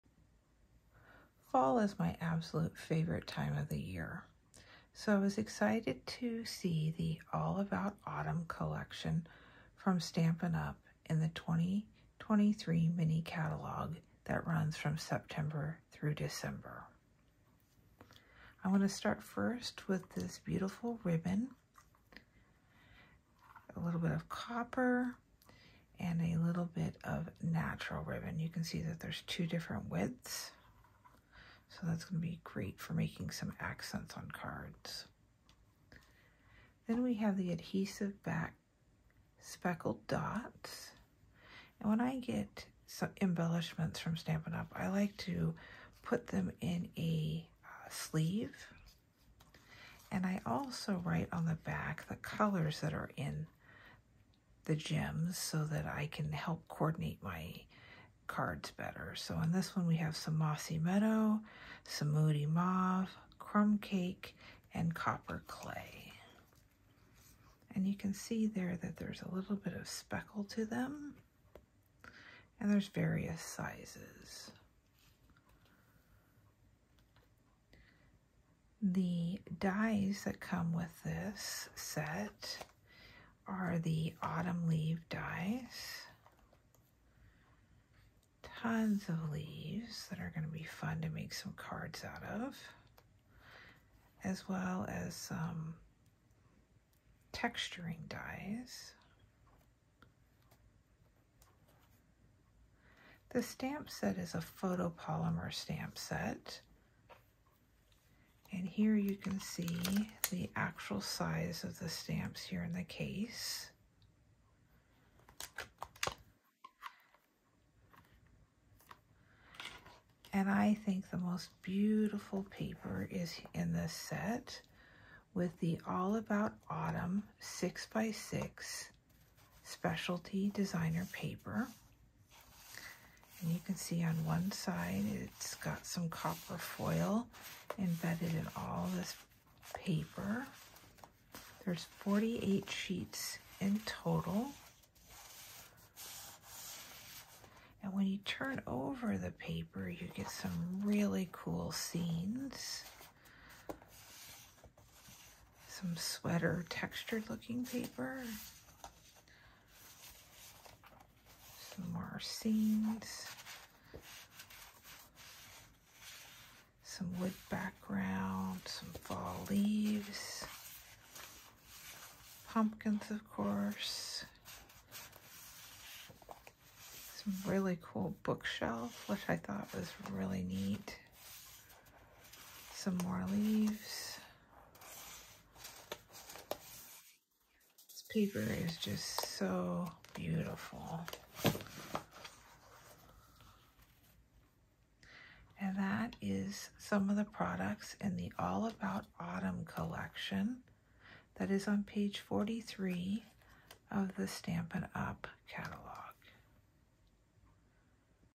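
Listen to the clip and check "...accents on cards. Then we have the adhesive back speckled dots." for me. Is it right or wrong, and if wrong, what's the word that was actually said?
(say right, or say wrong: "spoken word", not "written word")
right.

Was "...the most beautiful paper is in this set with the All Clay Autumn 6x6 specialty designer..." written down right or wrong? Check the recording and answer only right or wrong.
wrong.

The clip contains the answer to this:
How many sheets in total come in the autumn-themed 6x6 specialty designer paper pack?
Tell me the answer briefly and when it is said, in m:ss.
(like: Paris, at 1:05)
48, at 2:21.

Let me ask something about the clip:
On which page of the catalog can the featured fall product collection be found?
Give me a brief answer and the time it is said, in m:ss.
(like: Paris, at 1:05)
43, at 3:21.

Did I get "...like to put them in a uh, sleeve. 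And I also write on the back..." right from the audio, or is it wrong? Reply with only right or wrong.
right.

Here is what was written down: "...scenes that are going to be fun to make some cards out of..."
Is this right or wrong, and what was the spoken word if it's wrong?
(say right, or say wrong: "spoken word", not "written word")
wrong: "leaves", not "scenes".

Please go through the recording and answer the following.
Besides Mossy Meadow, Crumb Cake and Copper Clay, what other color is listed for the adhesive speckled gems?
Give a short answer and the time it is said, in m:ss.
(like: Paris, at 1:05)
Moody Mauve, at 1:02.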